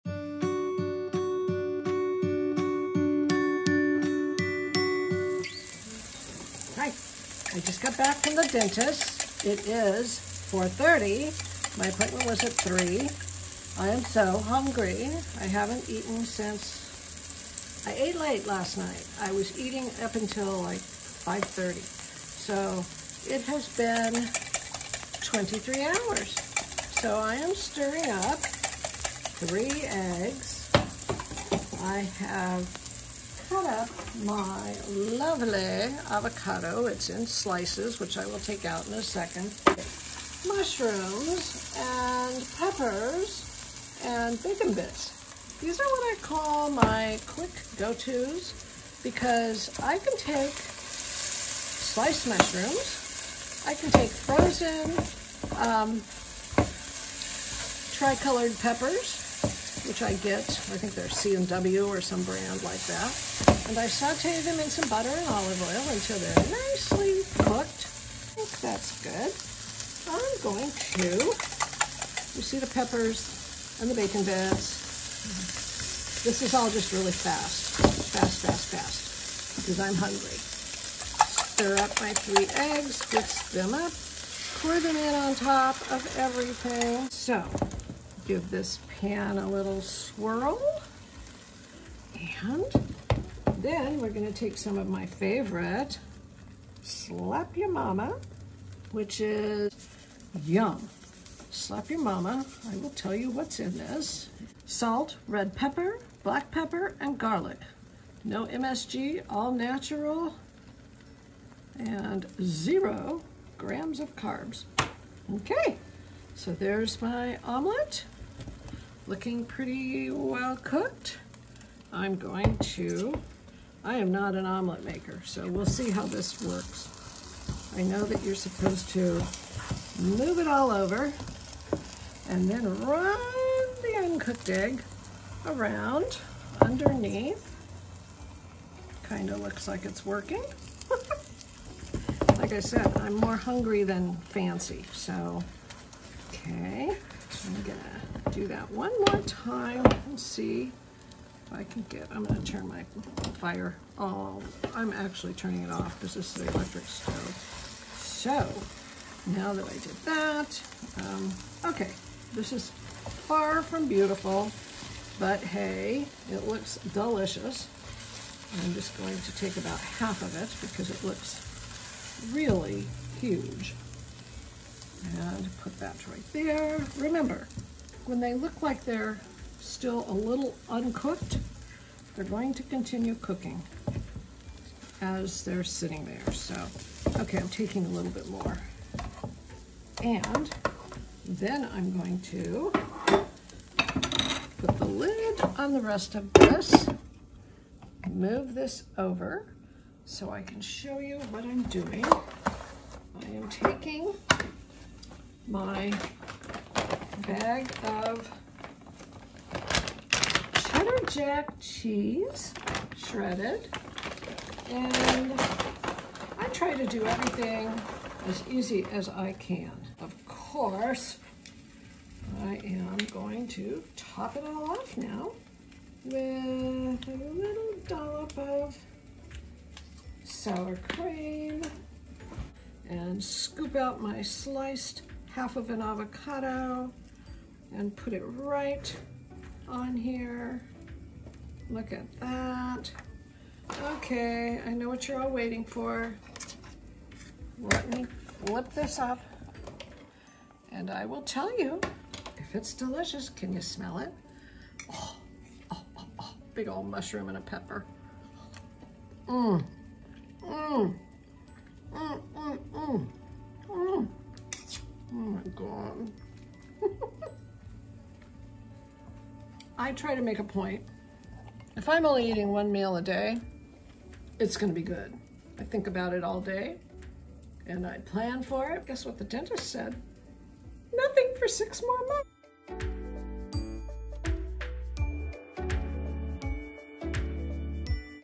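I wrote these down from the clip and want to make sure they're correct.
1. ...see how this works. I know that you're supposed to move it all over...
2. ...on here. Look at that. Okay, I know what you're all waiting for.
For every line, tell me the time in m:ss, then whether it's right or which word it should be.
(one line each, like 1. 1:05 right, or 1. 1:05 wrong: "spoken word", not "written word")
1. 2:05 right
2. 3:59 right.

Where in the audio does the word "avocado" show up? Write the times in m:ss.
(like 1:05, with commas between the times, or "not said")
0:36, 3:55.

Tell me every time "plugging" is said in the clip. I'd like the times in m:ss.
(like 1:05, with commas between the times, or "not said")
not said.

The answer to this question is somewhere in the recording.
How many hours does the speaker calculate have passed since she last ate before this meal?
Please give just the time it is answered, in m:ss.
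0:25.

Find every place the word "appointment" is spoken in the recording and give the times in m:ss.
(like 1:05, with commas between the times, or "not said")
0:11.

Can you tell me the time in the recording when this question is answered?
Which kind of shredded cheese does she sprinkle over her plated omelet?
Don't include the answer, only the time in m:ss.
3:30.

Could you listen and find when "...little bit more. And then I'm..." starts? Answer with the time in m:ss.
3:07.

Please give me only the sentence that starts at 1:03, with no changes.
And I saute them in some butter and olive oil until they're nicely cooked.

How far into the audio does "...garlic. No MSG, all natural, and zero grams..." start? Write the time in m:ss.
1:47.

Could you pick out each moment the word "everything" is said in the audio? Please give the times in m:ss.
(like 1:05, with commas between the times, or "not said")
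1:26, 3:37.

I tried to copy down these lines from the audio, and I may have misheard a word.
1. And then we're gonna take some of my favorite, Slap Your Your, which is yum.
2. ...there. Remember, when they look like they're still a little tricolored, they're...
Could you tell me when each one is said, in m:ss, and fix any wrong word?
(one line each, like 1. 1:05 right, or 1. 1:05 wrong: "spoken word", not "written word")
1. 1:32 wrong: "Mama", not "Your"
2. 2:56 wrong: "uncooked", not "tricolored".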